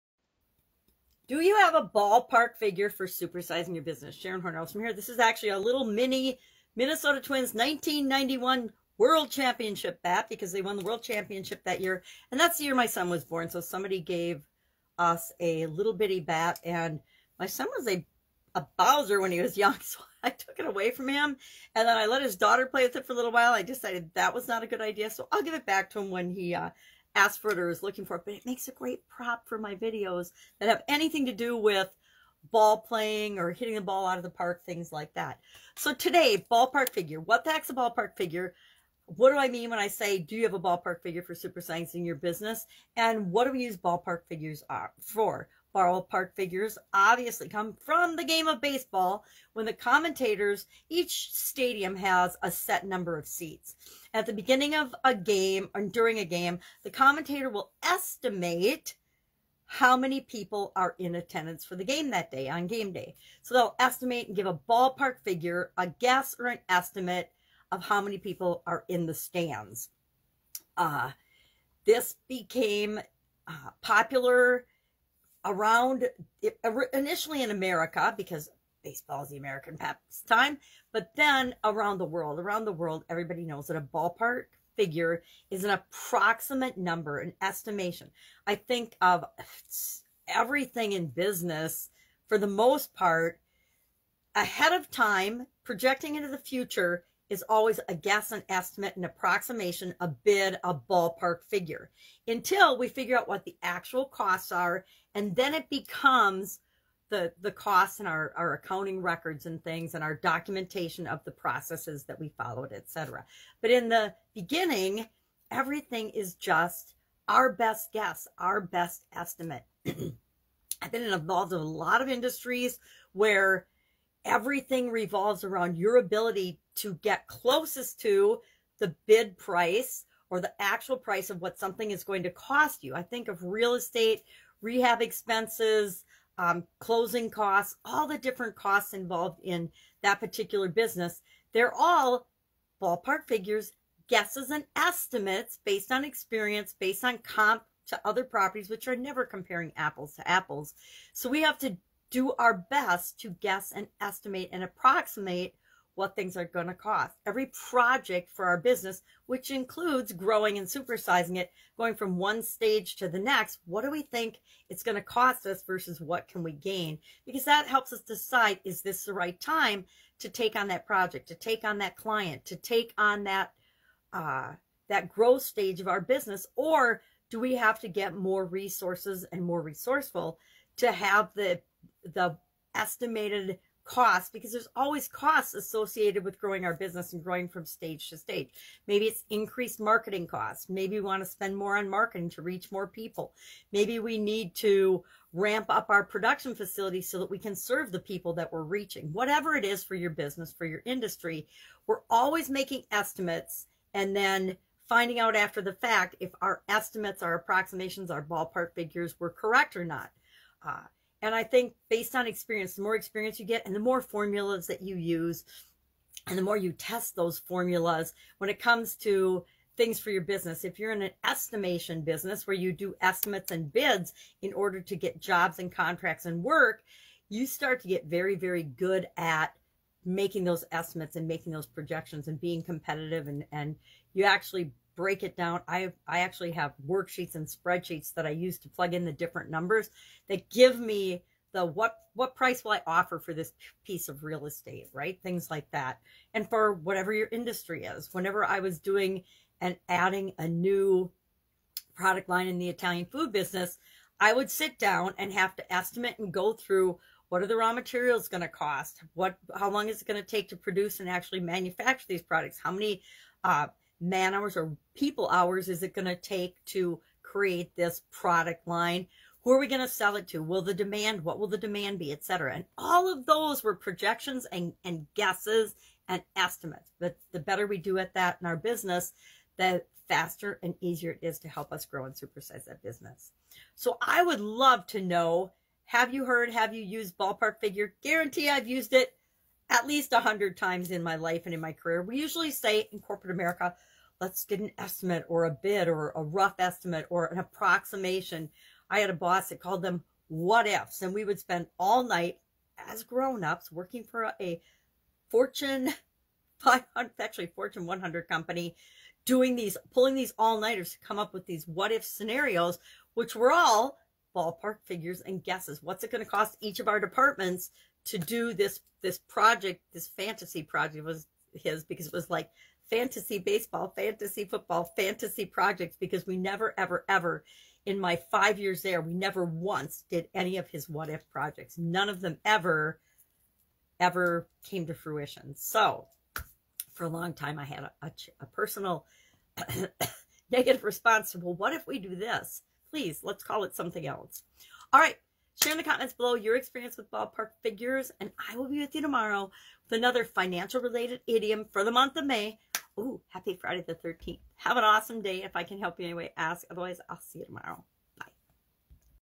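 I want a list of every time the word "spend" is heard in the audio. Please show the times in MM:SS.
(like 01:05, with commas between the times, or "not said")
03:11, 05:01.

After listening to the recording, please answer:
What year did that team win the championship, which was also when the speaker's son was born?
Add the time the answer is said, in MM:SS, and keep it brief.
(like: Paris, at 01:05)
1991, at 00:07.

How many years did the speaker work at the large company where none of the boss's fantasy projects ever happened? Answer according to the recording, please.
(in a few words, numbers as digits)
5.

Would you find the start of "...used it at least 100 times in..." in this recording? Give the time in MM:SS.
04:48.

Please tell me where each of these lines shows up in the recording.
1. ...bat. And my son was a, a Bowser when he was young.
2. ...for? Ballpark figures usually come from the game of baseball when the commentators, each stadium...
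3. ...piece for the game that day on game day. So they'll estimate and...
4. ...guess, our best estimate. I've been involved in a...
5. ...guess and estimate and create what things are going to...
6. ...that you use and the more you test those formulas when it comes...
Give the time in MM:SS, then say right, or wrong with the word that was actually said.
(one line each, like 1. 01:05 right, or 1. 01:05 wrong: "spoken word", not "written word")
1. 00:16 right
2. 00:45 wrong: "obviously", not "usually"
3. 01:01 wrong: "attendance", not "piece"
4. 01:57 right
5. 02:33 wrong: "approximate", not "create"
6. 03:34 right.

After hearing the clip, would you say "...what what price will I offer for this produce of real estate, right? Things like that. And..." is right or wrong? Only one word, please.
wrong.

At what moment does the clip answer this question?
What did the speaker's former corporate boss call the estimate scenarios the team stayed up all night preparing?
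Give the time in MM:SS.
05:00.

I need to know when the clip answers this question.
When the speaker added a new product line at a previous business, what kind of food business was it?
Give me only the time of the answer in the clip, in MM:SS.
04:12.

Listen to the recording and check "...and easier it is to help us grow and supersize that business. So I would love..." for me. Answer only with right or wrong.
right.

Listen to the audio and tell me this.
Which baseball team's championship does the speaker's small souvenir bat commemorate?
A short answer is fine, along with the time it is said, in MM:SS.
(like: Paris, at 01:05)
Minnesota Twins, at 00:06.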